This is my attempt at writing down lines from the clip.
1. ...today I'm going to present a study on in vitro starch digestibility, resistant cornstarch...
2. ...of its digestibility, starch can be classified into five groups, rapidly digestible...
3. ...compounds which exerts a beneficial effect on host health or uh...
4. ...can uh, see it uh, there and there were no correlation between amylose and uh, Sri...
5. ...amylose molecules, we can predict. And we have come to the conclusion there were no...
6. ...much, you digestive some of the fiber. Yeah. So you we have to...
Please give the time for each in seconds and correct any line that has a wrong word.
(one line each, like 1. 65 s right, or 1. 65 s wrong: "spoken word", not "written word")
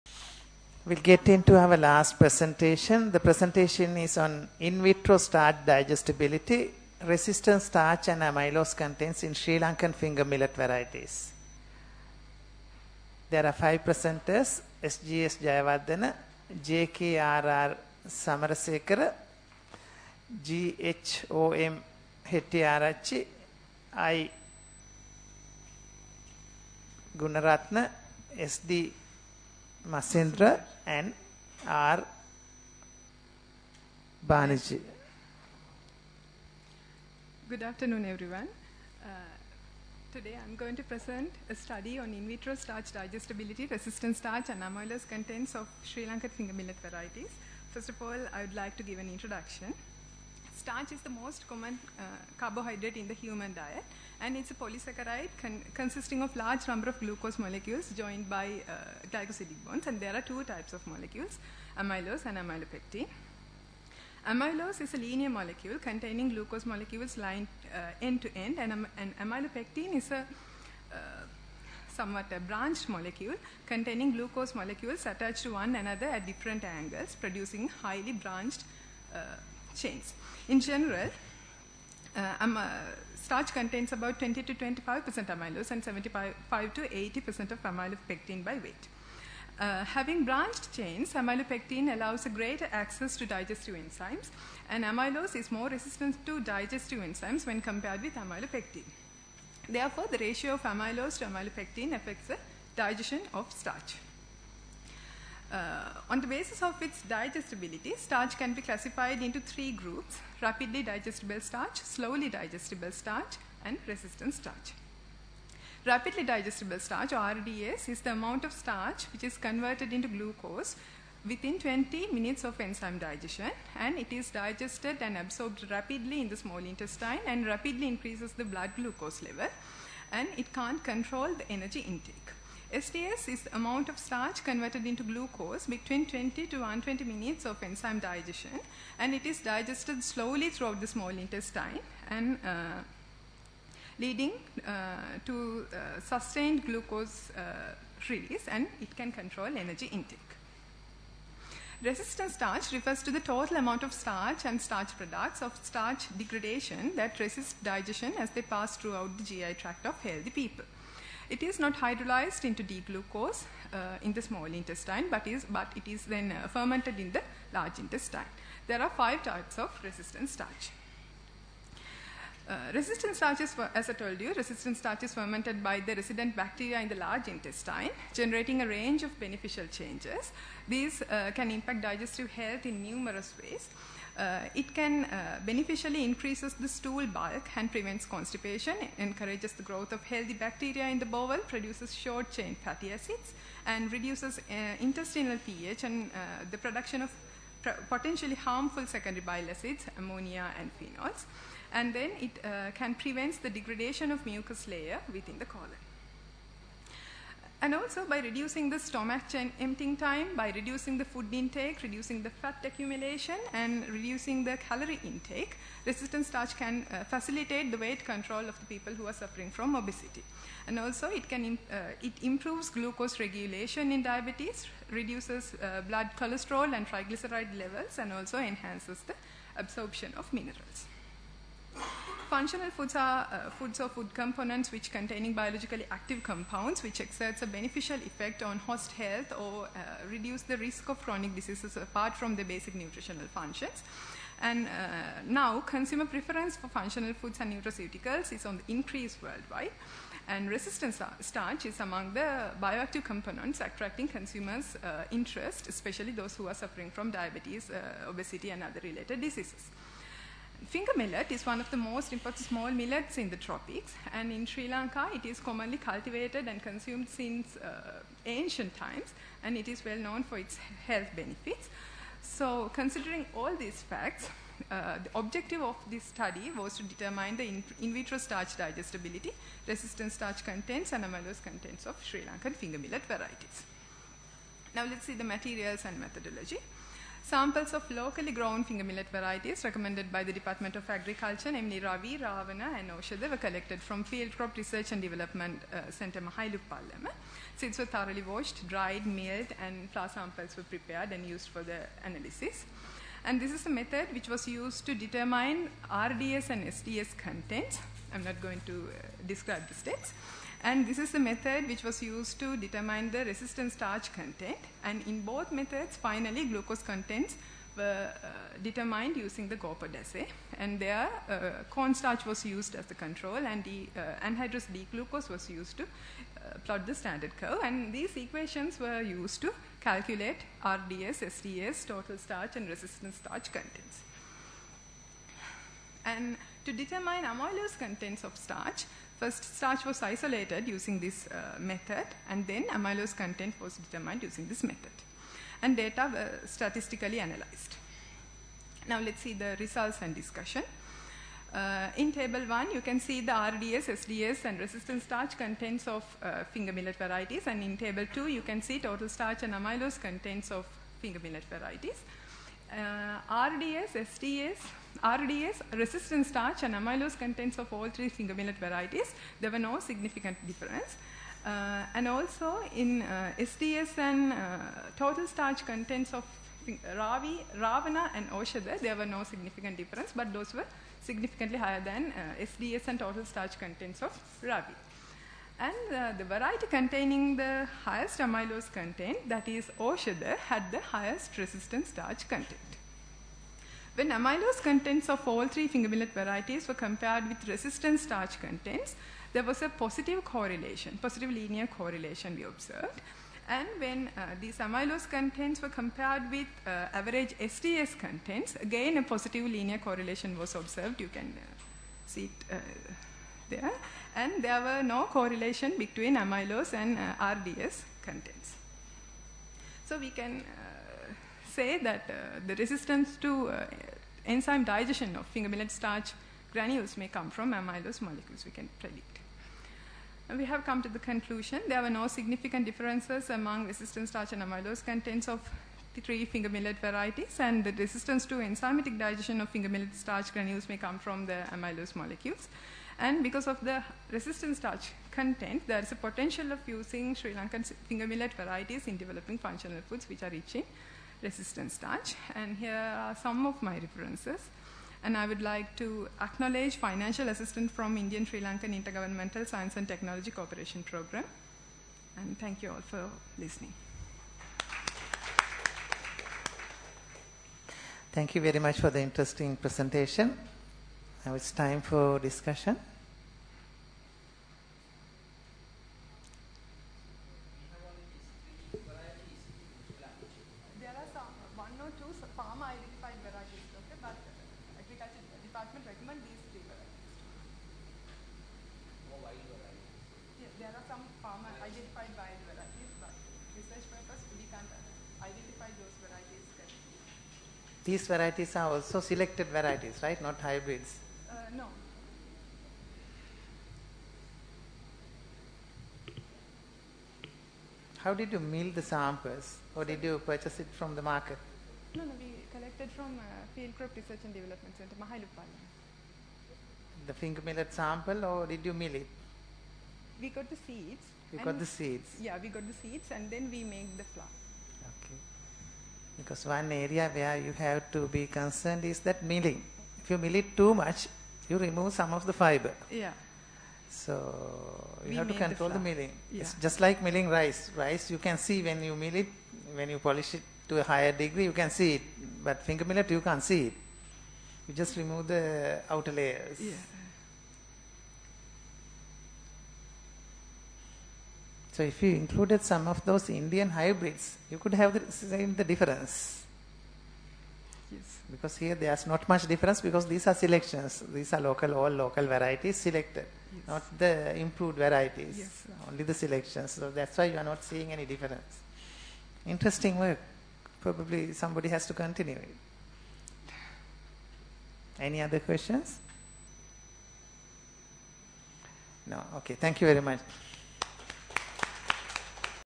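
1. 40 s wrong: "starch", not "cornstarch"
2. 106 s wrong: "three", not "five"
3. 236 s right
4. 411 s wrong: "RDS", not "Sri"
5. 427 s right
6. 530 s wrong: "remove", not "digestive".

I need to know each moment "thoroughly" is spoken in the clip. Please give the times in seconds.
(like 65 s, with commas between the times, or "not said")
297 s.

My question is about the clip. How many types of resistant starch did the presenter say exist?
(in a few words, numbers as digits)
5.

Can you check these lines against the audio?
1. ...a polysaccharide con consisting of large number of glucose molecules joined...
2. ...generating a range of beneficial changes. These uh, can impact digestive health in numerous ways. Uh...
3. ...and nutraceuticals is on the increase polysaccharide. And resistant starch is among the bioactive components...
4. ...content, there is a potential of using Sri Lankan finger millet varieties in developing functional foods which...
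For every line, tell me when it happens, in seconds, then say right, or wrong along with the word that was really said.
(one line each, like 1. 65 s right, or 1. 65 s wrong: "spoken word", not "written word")
1. 54 s right
2. 178 s right
3. 247 s wrong: "worldwide", not "polysaccharide"
4. 445 s right.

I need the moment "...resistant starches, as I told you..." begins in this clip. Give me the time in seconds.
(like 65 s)
172 s.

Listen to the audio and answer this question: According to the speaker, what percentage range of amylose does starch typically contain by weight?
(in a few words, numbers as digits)
20 to 25 percent.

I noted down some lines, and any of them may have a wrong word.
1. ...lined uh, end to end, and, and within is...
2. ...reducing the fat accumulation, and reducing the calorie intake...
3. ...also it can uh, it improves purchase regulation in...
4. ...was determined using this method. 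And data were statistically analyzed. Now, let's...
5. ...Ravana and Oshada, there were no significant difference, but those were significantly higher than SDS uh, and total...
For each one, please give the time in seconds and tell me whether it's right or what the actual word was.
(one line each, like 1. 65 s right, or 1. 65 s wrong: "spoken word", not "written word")
1. 67 s wrong: "amylopectin", not "within"
2. 211 s right
3. 220 s wrong: "glucose", not "purchase"
4. 343 s right
5. 377 s right.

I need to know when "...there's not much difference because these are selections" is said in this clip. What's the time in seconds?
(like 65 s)
558 s.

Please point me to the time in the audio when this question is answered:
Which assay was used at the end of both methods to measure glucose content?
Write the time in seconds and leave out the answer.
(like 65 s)
319 s.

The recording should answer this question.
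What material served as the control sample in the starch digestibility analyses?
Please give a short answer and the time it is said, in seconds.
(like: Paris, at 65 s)
cornstarch, at 321 s.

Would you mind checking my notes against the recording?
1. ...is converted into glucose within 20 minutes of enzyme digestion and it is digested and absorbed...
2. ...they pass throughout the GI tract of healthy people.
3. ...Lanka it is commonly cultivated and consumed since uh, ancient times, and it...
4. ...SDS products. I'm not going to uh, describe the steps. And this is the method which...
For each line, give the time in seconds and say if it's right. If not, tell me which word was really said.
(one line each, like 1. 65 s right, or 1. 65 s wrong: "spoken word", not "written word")
1. 119 s right
2. 158 s right
3. 264 s right
4. 306 s wrong: "contents", not "products".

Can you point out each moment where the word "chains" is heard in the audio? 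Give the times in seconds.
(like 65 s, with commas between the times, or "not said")
79 s, 90 s, 191 s.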